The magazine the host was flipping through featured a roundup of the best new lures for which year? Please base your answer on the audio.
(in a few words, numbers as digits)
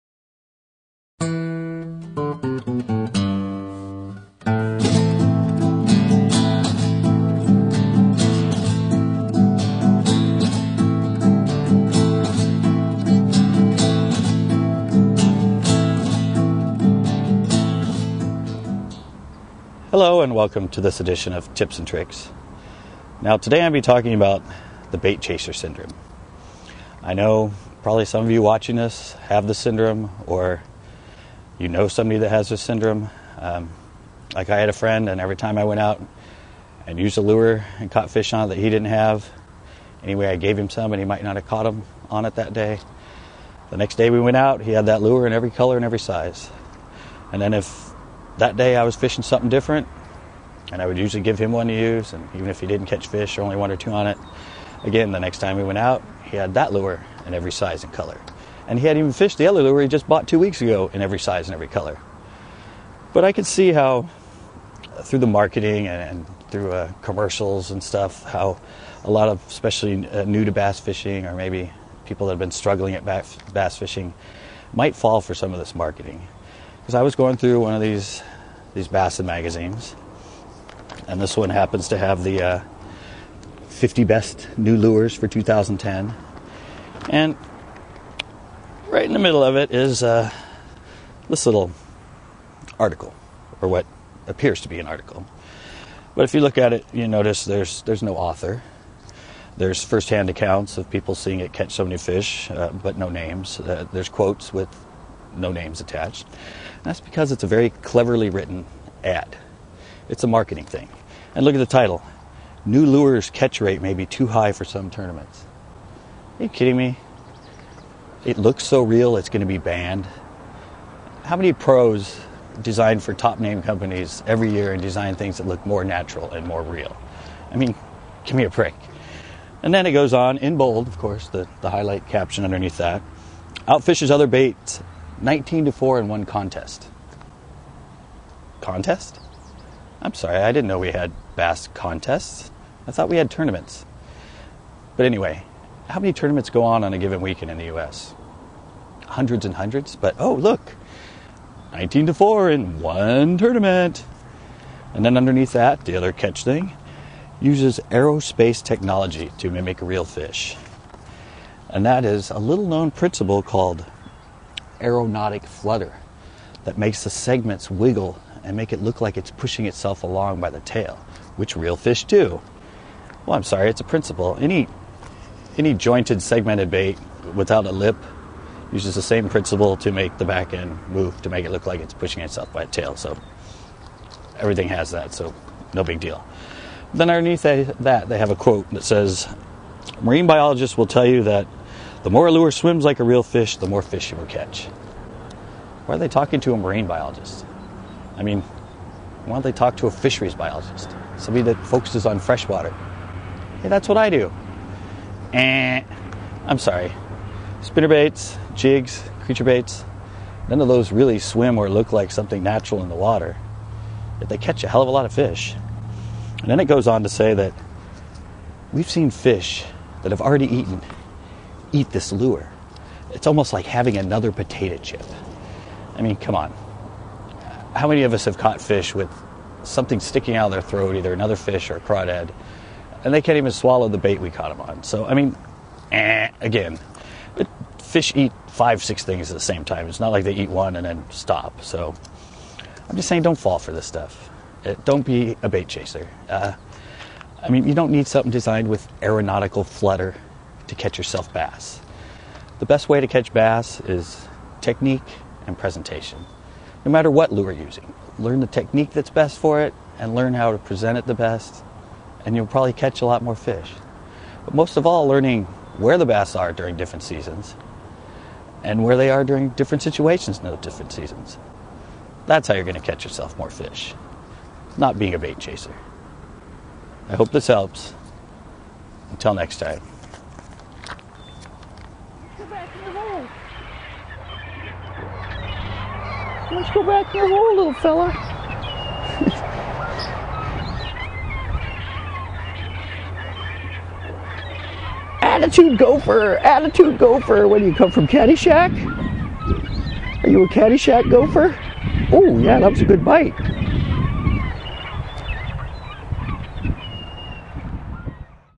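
2010.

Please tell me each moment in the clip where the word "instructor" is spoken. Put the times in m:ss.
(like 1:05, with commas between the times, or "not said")
not said.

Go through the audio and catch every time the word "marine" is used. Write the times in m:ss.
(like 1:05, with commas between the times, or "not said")
3:10, 3:16.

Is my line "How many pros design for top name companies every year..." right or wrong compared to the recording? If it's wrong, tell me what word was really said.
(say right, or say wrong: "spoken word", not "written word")
right.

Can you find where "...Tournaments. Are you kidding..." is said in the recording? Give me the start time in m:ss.
1:54.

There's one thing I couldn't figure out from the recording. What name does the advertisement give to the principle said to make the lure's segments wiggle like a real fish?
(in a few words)
aeronautic flutter.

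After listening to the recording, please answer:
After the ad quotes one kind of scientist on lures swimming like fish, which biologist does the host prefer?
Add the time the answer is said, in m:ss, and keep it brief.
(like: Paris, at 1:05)
fisheries biologist, at 3:19.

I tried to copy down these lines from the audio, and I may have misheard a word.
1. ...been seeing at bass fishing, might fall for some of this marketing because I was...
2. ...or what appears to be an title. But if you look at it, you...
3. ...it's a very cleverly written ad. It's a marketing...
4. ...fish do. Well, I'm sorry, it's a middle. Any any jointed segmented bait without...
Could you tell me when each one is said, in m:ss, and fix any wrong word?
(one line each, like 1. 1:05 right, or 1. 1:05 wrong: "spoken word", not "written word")
1. 1:12 wrong: "struggling", not "seeing"
2. 1:33 wrong: "article", not "title"
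3. 1:47 right
4. 2:51 wrong: "principle", not "middle".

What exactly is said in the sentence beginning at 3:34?
Yet they catch a hell of a lot of fish.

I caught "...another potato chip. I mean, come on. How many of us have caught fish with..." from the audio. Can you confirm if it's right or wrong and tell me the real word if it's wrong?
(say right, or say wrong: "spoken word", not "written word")
right.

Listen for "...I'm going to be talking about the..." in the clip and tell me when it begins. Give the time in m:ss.
0:23.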